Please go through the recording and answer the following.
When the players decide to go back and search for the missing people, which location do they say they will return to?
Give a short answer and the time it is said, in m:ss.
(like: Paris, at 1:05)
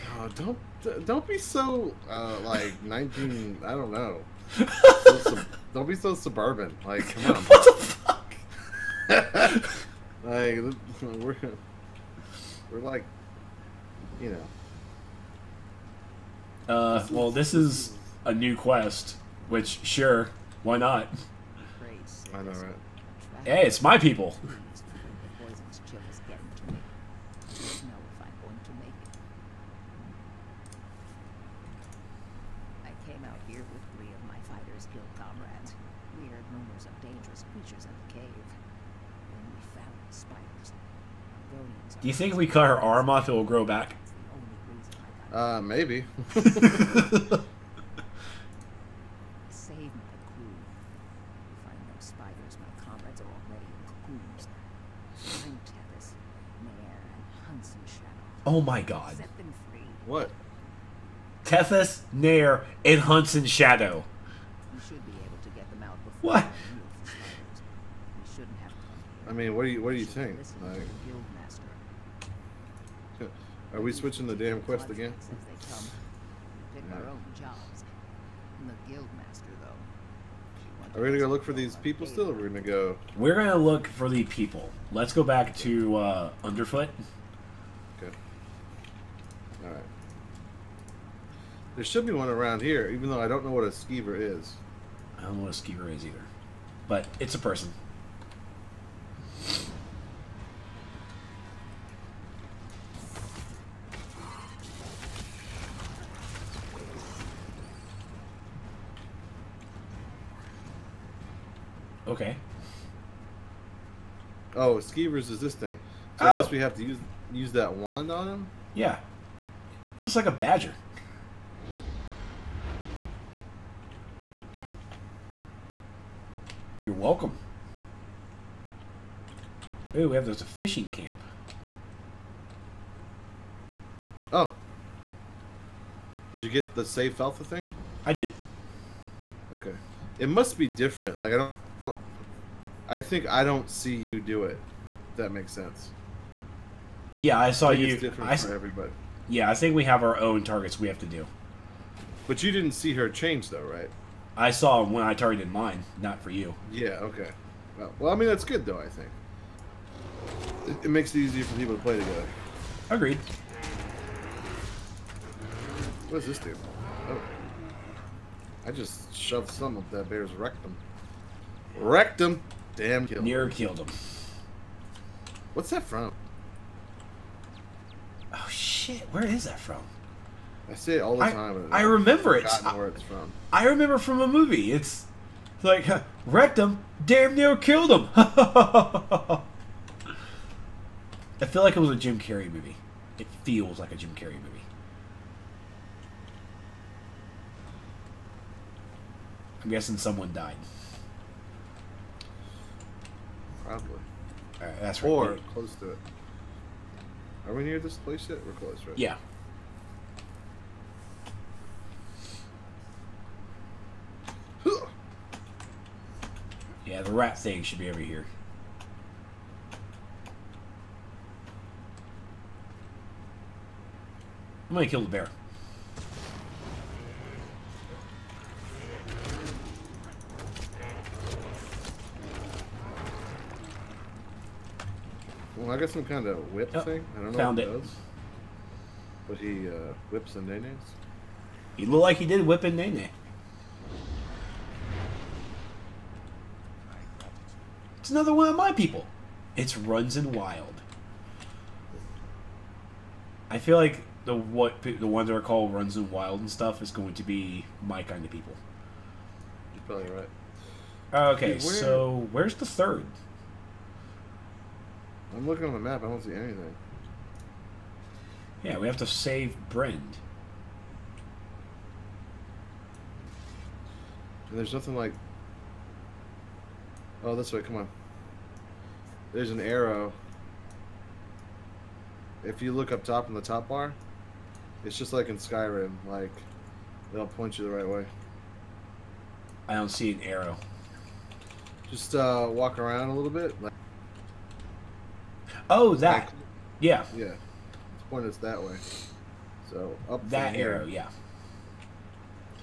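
Underfoot, at 1:26.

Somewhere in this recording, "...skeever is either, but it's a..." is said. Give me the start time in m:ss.
1:35.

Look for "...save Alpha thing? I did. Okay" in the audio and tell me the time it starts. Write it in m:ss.
2:16.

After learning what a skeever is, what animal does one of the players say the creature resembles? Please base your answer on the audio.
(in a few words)
A badger.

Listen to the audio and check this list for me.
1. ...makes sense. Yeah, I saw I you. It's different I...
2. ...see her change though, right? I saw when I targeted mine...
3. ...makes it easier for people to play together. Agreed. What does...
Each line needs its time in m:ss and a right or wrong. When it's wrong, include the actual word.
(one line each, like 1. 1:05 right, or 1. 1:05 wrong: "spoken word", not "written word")
1. 2:25 right
2. 2:32 right
3. 2:40 right.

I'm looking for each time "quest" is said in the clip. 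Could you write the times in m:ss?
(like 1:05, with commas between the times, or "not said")
0:18, 1:14.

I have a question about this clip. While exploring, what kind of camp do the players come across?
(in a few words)
Fishing camp.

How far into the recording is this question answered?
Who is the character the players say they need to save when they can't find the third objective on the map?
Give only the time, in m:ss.
4:29.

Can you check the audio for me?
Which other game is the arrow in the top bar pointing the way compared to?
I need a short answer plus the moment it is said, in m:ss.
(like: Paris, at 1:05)
Skyrim, at 4:45.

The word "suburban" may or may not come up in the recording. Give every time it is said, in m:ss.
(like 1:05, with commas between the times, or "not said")
0:06.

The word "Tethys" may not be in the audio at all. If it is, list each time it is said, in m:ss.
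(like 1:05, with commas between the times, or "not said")
1:01.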